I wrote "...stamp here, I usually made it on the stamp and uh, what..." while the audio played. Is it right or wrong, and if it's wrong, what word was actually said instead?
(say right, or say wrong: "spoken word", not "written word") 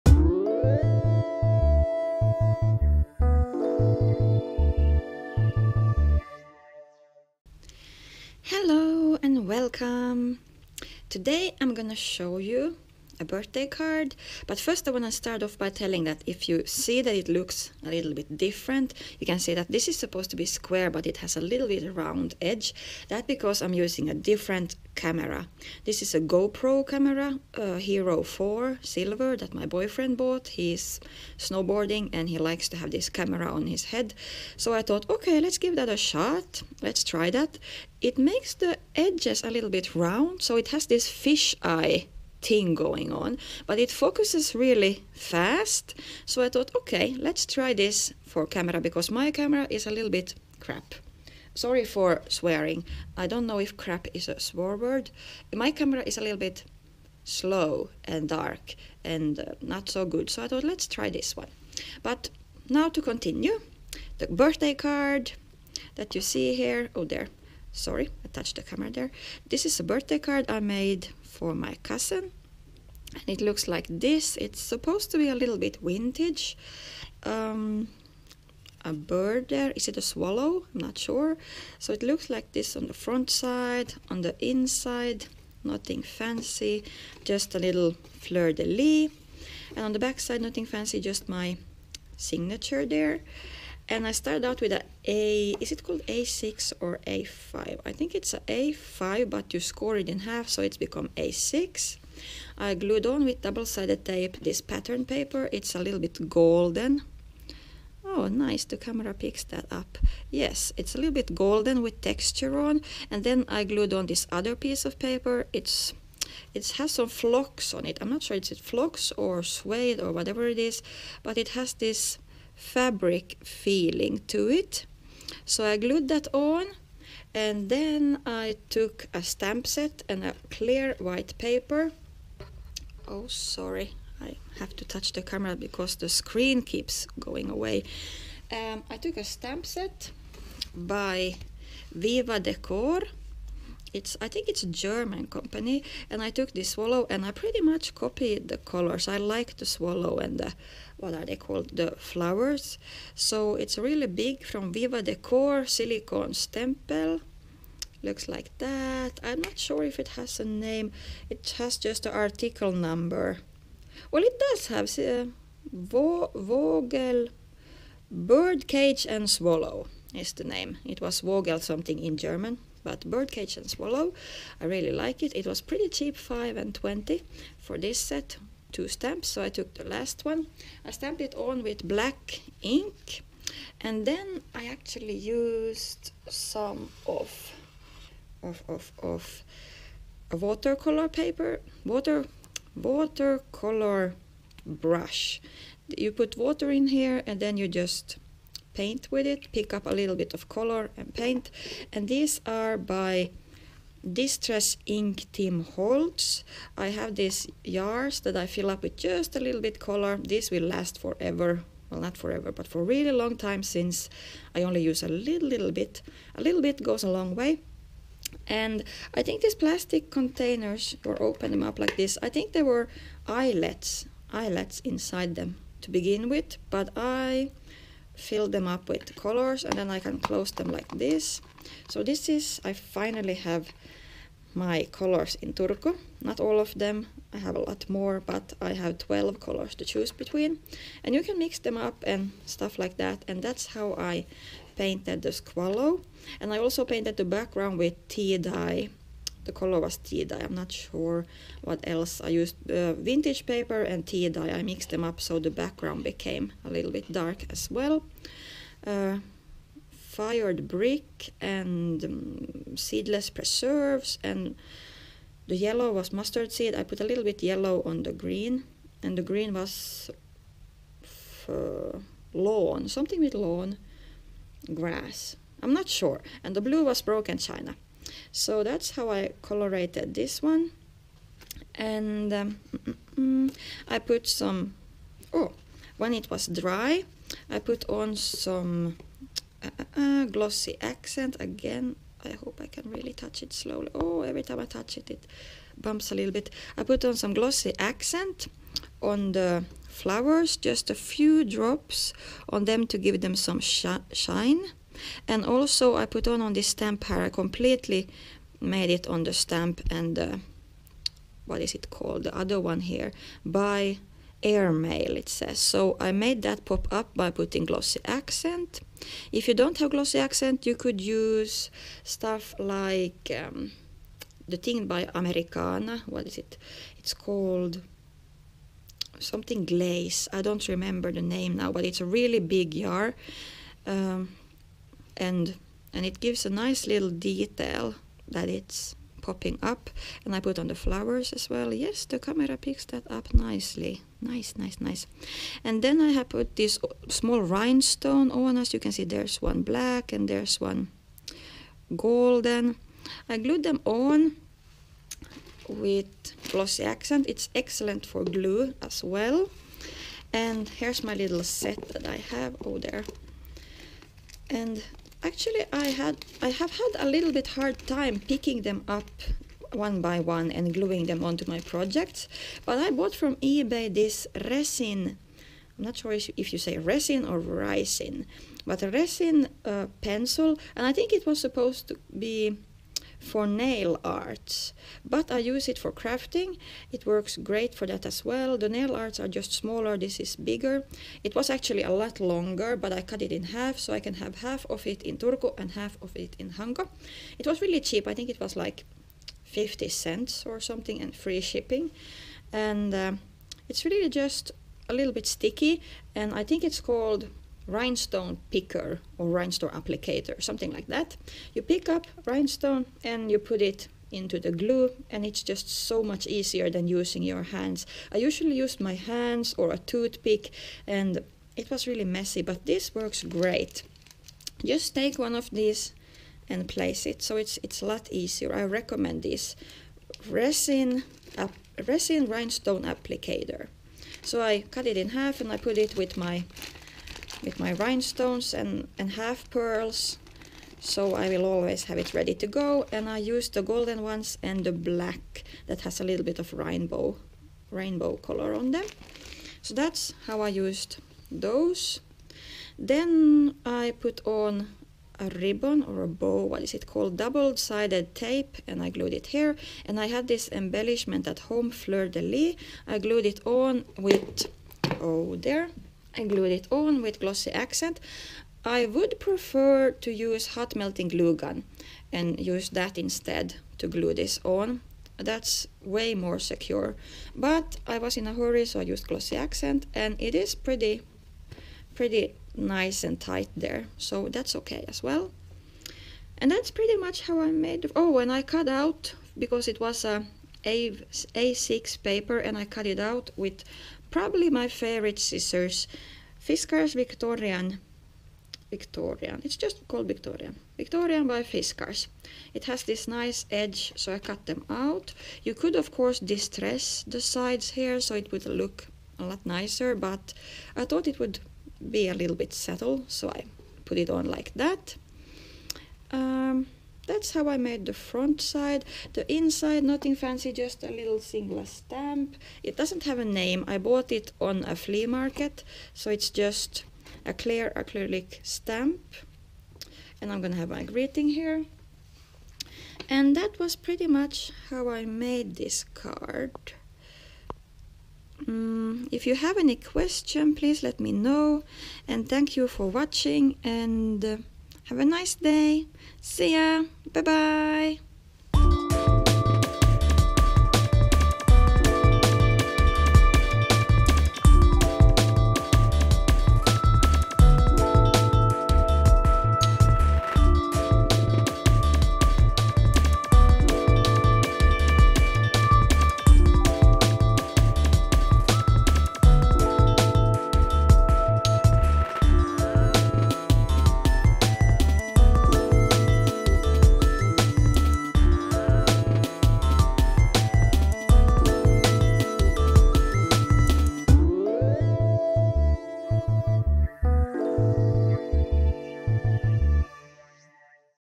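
wrong: "completely", not "usually".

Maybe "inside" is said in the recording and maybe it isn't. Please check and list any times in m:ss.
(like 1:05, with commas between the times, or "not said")
1:24, 3:44, 8:39.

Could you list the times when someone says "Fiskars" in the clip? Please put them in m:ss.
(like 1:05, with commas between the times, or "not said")
8:16, 8:21.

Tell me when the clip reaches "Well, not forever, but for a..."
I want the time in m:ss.
3:31.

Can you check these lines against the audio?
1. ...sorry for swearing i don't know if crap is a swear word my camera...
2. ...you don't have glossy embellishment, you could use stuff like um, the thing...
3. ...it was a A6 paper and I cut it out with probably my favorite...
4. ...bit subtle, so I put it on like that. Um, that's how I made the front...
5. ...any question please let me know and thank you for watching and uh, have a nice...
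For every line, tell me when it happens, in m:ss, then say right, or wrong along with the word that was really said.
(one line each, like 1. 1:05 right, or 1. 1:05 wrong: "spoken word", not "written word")
1. 0:51 right
2. 5:19 wrong: "accent", not "embellishment"
3. 8:09 right
4. 8:32 right
5. 8:59 right.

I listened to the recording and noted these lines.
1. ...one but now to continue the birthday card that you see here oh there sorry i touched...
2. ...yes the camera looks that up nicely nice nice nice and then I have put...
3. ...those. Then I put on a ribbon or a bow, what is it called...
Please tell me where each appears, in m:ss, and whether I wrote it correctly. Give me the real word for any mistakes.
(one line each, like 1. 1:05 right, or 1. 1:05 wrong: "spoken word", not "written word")
1. 1:01 right
2. 5:41 wrong: "picks", not "looks"
3. 7:31 right.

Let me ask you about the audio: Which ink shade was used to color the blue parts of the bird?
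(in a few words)
Broken China.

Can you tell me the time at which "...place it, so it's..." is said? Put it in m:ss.
7:06.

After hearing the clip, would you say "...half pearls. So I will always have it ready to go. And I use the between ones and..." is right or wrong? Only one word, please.
wrong.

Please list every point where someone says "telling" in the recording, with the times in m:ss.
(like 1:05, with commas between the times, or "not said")
0:15.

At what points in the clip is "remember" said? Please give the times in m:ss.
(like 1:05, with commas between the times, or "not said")
5:30.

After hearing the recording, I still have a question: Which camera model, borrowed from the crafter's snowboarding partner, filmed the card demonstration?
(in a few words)
Hero 4 Silver.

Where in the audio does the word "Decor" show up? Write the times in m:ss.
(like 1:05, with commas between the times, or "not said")
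2:22, 2:35.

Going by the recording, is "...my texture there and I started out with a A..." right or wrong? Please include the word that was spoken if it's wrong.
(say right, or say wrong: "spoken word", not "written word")
wrong: "signature", not "texture".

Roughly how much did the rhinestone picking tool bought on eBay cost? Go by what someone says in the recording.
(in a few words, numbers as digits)
50 cents.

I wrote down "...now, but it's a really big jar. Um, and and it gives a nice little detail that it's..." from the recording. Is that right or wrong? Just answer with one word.
right.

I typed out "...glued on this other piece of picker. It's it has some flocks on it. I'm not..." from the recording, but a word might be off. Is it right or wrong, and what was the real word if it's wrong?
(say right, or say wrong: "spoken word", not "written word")
wrong: "paper", not "picker".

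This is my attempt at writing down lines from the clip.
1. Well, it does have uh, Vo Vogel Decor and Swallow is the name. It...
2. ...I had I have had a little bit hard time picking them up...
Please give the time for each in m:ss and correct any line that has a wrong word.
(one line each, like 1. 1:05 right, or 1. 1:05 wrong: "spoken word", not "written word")
1. 2:44 wrong: "Birdcage", not "Decor"
2. 6:05 right.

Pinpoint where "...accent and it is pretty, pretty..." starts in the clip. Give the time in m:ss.
7:59.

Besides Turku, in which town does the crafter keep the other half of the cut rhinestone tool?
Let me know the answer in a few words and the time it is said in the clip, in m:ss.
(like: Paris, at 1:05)
Hanko, at 6:36.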